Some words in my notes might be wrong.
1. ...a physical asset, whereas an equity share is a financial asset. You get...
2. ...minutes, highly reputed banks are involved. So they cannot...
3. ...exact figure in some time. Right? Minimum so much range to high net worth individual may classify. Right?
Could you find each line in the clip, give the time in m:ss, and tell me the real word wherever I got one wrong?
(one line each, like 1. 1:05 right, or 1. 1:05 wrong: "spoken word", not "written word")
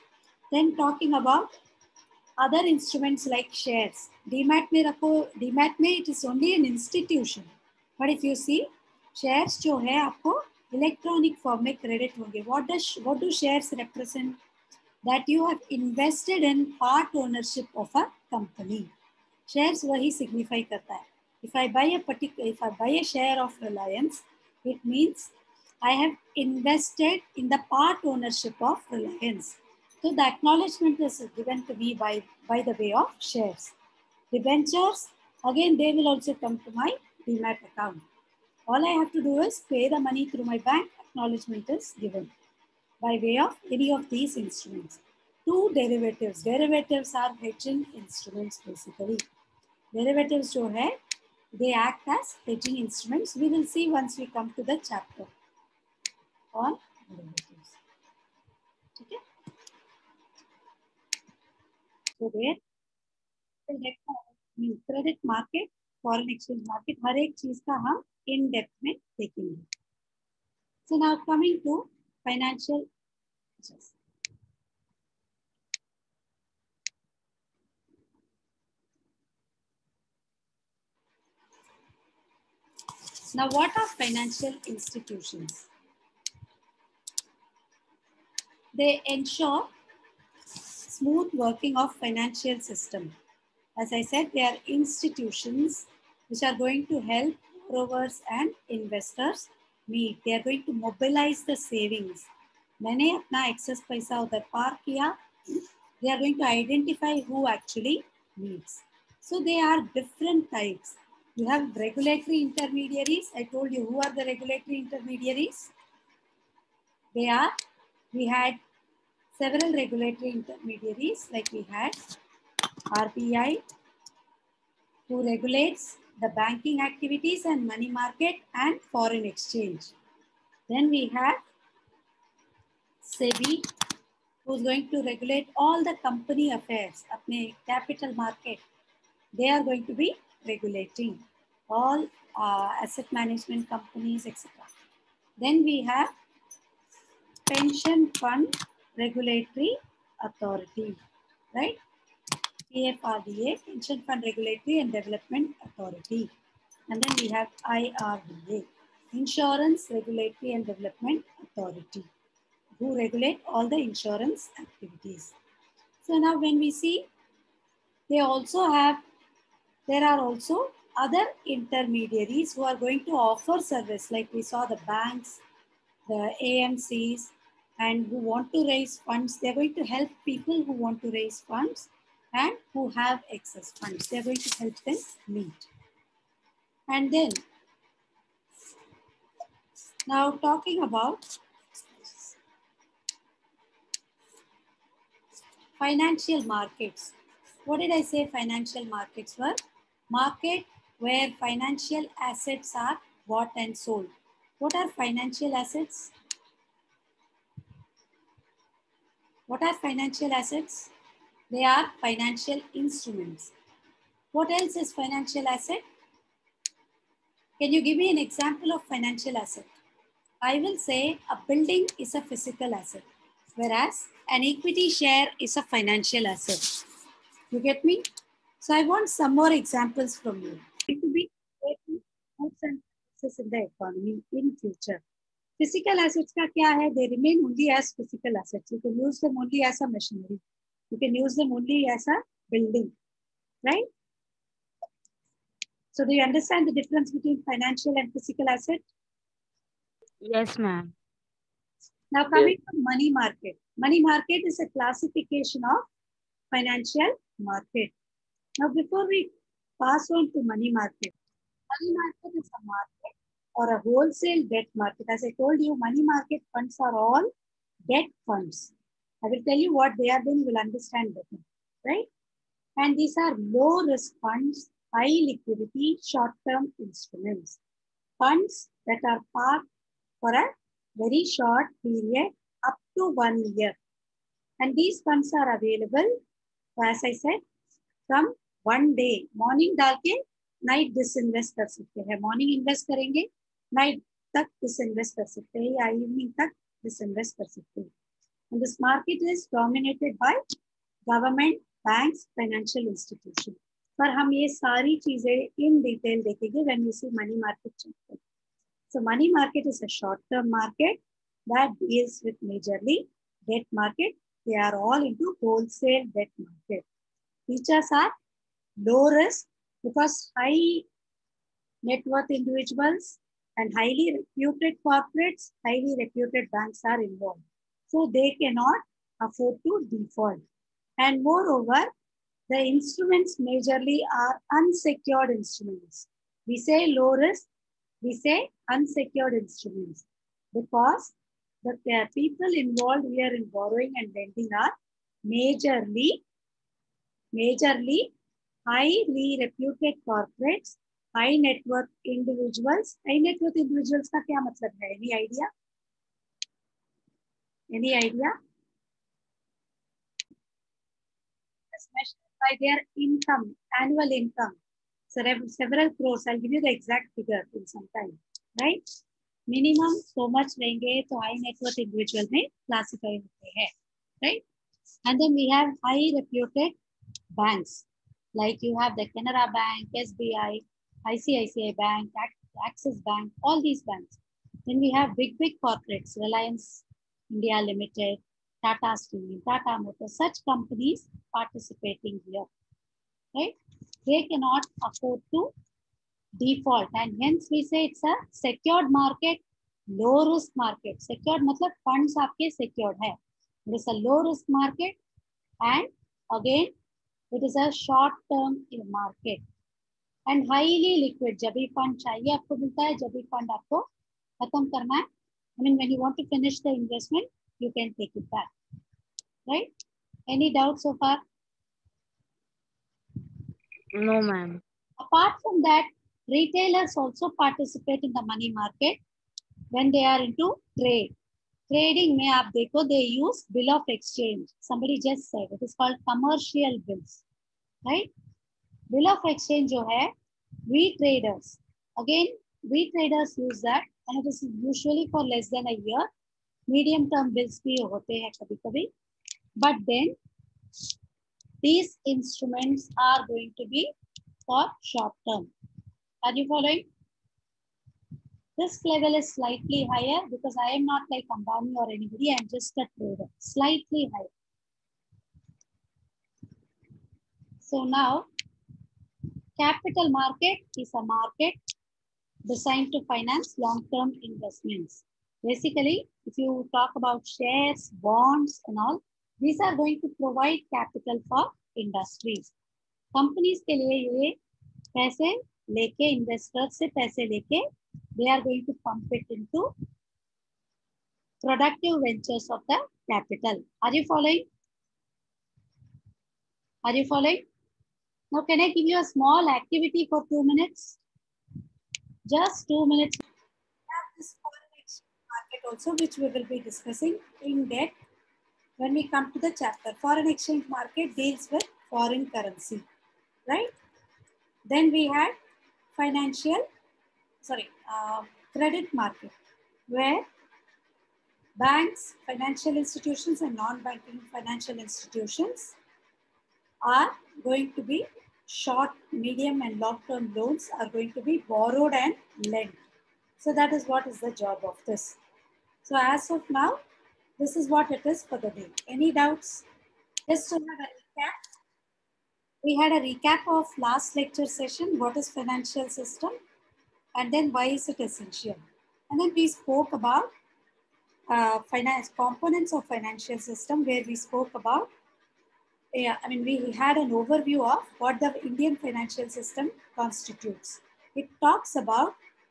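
1. 3:42 right
2. 5:24 wrong: "corporates", not "minutes"
3. 6:06 right.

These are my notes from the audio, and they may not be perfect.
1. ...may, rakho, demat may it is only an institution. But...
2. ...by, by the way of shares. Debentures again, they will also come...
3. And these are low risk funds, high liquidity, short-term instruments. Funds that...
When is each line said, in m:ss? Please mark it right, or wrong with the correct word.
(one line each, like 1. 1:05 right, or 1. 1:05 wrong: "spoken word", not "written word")
1. 0:04 right
2. 0:31 right
3. 4:32 right.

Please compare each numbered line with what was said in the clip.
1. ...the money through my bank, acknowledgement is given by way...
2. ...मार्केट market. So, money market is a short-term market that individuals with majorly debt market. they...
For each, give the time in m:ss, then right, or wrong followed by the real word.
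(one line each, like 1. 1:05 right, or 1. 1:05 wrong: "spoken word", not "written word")
1. 0:39 right
2. 5:07 wrong: "deals", not "individuals".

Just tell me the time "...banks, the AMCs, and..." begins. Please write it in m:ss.
2:54.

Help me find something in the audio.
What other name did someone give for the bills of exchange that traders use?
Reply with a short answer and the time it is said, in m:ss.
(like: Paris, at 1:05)
Commercial bills, at 7:16.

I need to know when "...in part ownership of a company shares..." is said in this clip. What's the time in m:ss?
0:16.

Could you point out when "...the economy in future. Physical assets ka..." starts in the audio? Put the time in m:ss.
3:53.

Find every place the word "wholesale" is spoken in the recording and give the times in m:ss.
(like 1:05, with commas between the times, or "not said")
4:23, 5:15.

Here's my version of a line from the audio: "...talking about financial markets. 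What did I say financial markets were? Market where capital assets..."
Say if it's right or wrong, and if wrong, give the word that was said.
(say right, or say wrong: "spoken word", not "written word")
wrong: "financial", not "capital".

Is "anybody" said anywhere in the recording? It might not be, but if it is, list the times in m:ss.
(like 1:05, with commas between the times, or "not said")
7:41.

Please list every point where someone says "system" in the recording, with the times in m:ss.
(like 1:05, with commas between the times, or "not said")
1:32, 9:05, 9:13, 9:19.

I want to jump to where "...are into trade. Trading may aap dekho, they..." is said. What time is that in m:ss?
7:10.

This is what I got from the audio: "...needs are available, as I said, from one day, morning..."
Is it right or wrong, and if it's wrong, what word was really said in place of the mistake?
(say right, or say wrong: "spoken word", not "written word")
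wrong: "funds", not "needs".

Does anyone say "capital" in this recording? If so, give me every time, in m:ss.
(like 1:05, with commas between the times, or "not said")
2:17, 7:49, 8:00, 8:13.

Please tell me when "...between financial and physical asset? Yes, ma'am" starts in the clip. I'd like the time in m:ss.
4:07.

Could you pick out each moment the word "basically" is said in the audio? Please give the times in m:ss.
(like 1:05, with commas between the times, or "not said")
0:48, 7:55.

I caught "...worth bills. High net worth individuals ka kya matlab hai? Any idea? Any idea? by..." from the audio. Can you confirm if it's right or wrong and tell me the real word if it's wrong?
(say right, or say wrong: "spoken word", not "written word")
wrong: "individuals", not "bills".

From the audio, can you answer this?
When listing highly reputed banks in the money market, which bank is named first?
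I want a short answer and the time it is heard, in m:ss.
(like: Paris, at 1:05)
Canara Bank, at 6:19.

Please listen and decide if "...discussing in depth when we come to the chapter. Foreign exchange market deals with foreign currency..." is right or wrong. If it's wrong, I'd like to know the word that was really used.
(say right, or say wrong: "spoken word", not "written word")
right.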